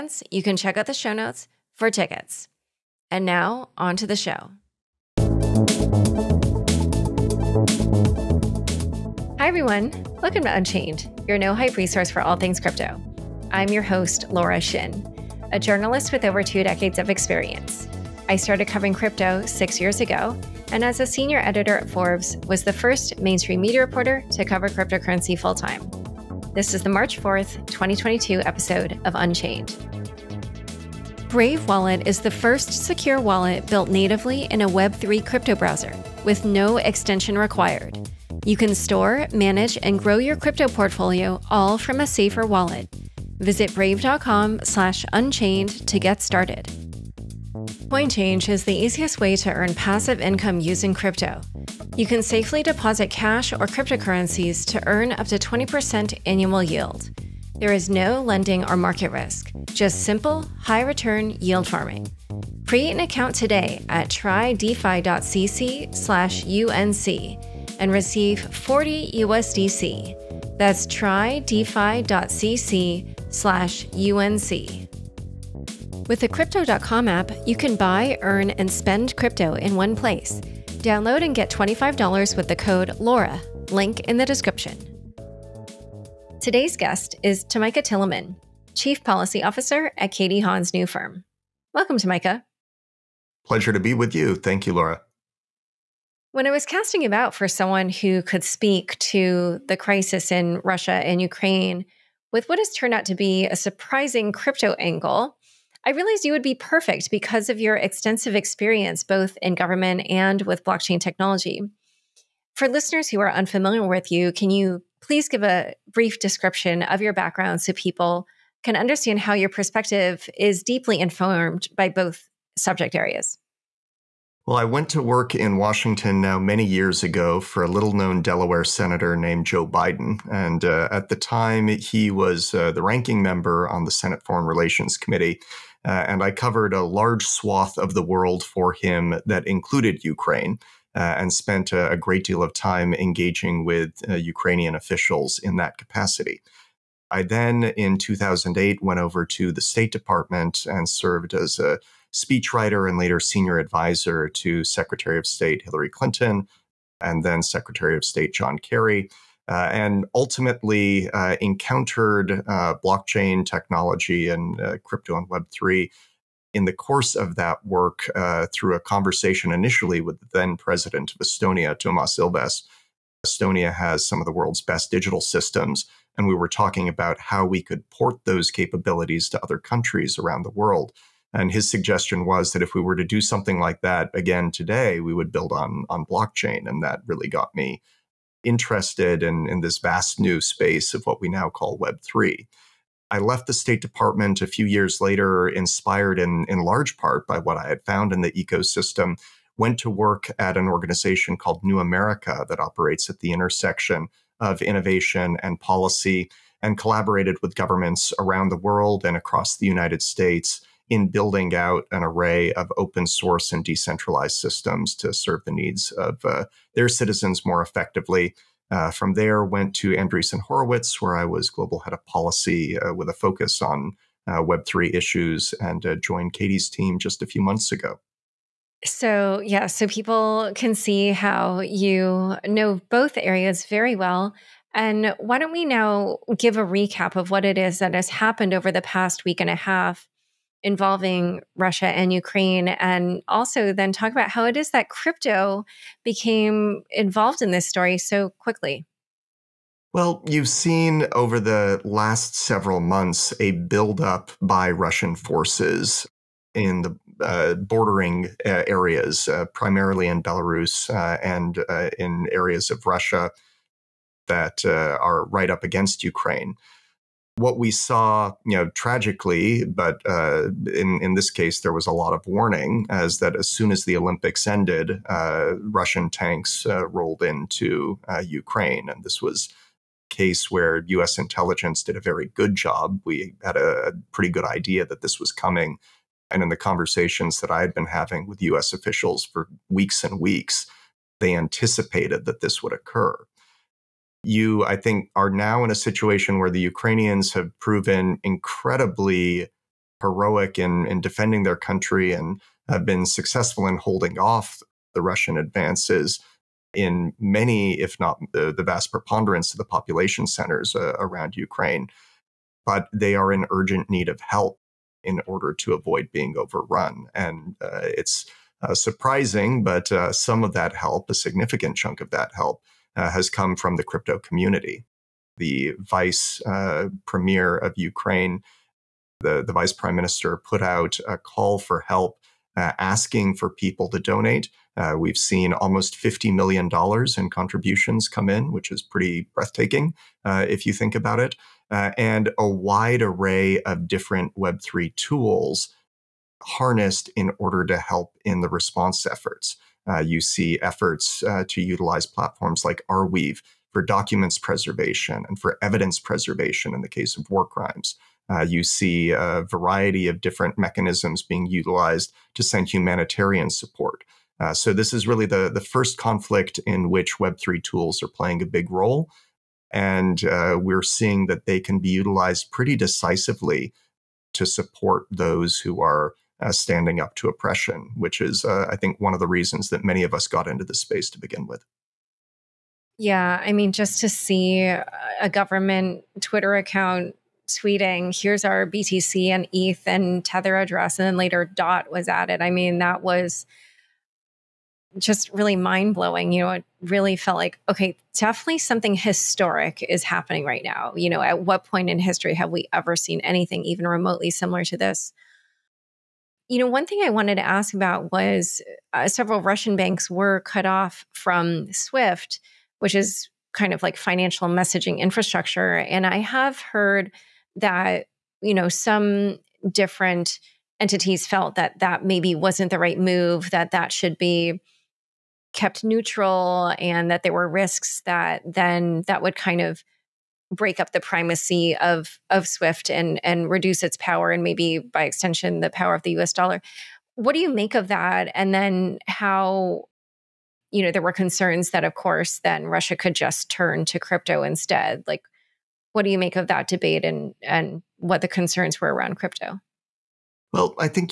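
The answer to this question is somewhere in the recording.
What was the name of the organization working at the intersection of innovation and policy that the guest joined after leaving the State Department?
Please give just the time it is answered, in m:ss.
3:21.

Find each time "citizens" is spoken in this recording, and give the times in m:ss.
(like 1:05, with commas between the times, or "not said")
3:36.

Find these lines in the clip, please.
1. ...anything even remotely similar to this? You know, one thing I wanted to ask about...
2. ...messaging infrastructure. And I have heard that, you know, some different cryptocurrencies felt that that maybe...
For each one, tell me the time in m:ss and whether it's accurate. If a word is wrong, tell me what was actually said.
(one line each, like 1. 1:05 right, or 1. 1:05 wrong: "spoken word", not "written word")
1. 6:43 right
2. 6:54 wrong: "entities", not "cryptocurrencies".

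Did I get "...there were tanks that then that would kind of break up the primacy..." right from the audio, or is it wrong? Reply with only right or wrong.
wrong.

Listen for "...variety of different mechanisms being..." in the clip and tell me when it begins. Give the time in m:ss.
5:59.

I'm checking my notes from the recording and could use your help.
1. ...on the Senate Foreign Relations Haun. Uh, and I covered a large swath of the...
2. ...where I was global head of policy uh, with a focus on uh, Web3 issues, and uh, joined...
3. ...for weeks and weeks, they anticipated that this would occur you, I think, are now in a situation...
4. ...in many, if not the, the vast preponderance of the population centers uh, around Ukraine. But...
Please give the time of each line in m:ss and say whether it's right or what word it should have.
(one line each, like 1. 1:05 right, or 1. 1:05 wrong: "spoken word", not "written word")
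1. 2:13 wrong: "Committee", not "Haun"
2. 3:41 right
3. 4:49 right
4. 5:06 right.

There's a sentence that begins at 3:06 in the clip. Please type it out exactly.
And that really got me interested in, in this vast new space of what we now call Web3.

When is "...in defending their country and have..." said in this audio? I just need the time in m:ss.
5:00.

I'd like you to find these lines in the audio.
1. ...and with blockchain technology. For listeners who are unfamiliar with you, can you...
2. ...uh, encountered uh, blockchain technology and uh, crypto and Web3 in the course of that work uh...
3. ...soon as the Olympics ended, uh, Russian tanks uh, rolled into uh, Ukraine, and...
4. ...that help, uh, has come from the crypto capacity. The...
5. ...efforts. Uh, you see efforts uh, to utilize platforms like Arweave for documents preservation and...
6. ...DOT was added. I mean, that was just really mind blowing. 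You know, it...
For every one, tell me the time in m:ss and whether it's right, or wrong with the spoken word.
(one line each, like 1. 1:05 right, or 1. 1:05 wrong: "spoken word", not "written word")
1. 1:50 right
2. 2:41 right
3. 4:33 right
4. 5:22 wrong: "community", not "capacity"
5. 5:49 right
6. 6:31 right.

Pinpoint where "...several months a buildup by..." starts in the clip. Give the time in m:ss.
4:12.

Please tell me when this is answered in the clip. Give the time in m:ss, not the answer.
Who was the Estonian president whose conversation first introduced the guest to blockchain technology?
2:51.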